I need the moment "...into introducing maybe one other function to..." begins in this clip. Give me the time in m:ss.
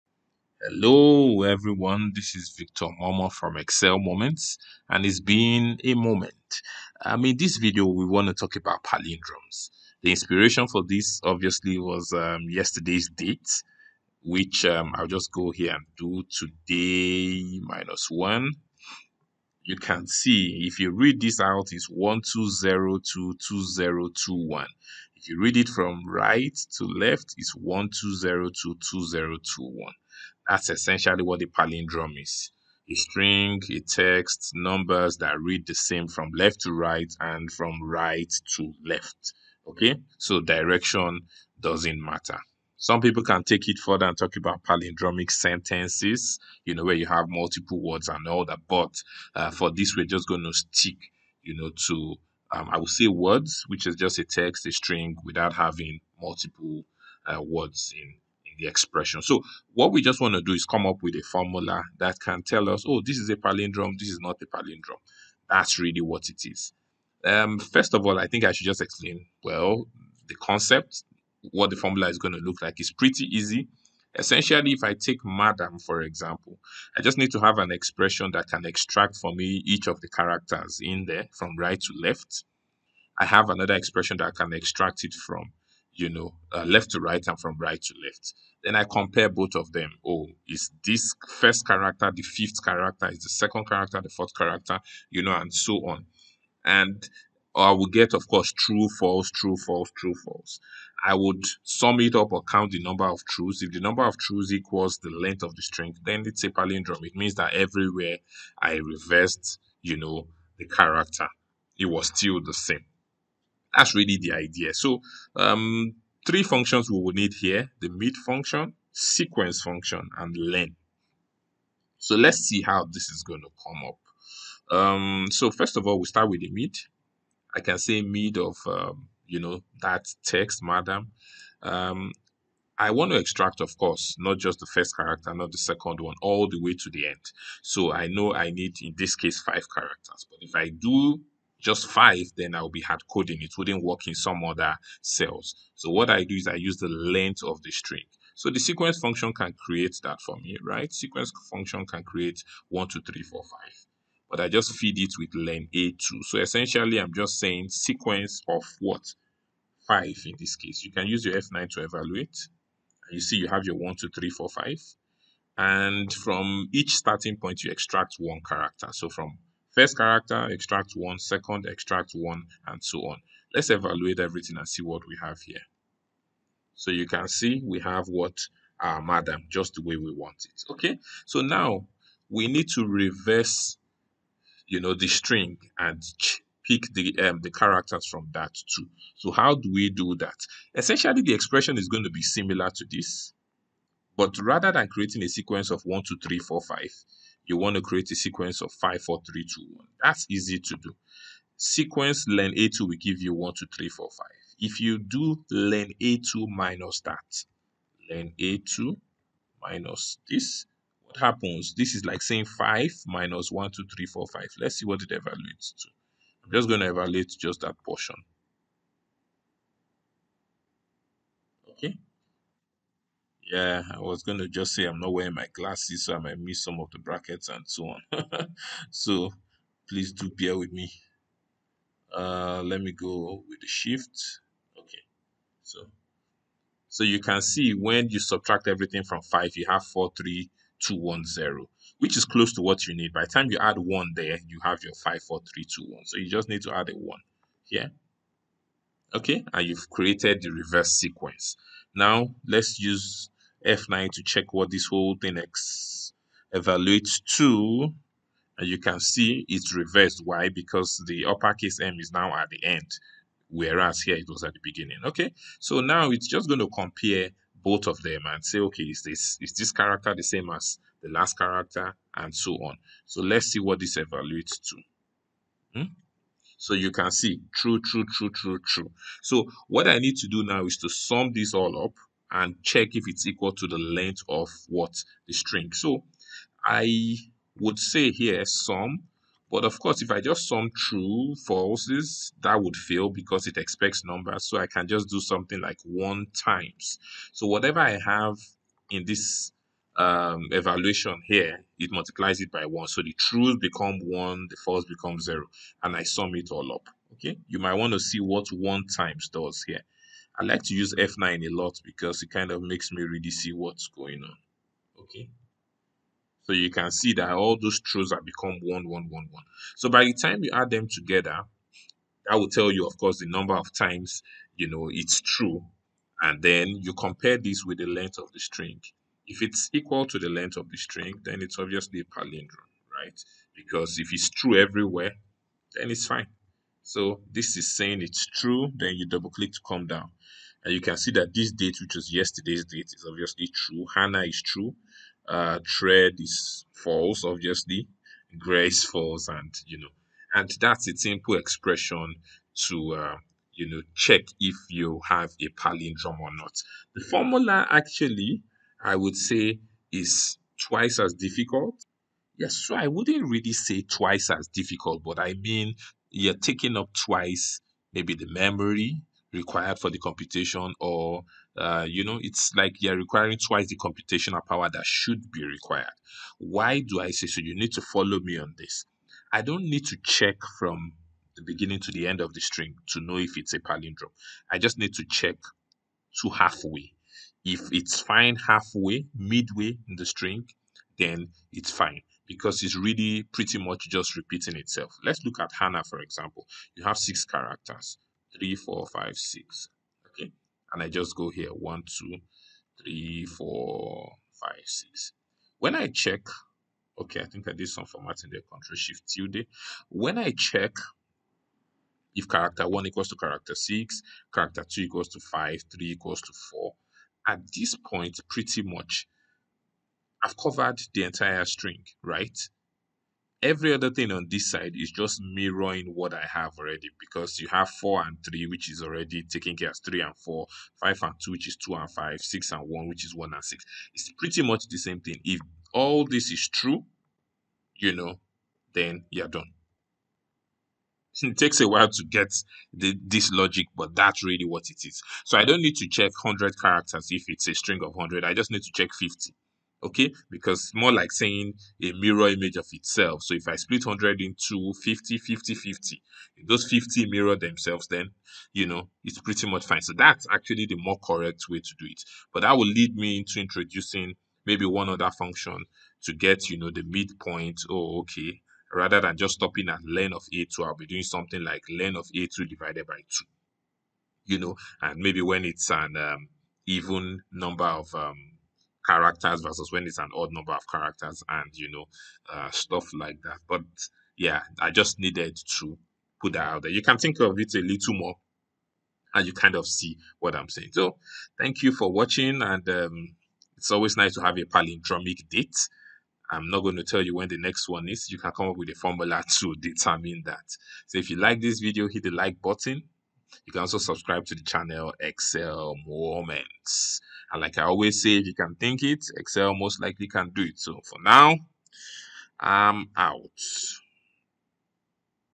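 7:43.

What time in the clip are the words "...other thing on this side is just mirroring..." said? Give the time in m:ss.
7:03.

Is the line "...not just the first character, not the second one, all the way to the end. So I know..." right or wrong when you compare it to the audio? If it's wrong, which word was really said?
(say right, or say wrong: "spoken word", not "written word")
right.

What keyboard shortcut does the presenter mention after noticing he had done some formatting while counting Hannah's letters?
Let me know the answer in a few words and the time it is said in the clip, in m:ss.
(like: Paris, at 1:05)
Control Shift Tilde, at 6:48.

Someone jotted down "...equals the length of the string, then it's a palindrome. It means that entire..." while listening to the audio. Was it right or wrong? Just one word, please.
wrong.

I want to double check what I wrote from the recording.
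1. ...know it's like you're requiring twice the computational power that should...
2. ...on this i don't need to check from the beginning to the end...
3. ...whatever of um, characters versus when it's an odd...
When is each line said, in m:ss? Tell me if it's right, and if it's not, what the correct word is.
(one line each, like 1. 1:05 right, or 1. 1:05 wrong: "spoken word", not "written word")
1. 6:12 right
2. 6:18 right
3. 7:57 wrong: "number", not "whatever".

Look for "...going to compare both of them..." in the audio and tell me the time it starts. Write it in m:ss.
4:26.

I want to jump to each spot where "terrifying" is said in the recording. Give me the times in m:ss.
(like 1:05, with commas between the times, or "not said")
not said.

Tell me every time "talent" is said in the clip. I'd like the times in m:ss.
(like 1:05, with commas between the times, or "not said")
not said.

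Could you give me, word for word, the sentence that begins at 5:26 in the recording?
And then you compare this with the length of the string.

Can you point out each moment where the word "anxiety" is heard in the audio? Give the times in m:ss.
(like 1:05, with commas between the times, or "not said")
not said.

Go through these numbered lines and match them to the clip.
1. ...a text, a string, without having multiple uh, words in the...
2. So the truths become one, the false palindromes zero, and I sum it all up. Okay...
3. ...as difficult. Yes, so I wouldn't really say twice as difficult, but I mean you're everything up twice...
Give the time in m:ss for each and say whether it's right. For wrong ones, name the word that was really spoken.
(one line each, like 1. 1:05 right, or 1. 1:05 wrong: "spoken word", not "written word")
1. 0:54 right
2. 5:02 wrong: "becomes", not "palindromes"
3. 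6:00 wrong: "taking", not "everything".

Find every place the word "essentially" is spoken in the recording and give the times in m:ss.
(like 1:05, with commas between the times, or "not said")
0:30, 1:14, 2:36, 3:10.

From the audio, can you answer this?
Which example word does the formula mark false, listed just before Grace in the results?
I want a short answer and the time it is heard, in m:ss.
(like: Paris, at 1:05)
thread, at 5:45.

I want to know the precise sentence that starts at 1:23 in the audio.
I have another expression that I can extract it from you know, uh, left to right and from right to left.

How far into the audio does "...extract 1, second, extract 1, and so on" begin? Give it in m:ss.
2:50.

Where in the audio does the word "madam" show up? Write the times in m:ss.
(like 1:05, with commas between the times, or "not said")
1:15, 2:10, 2:59.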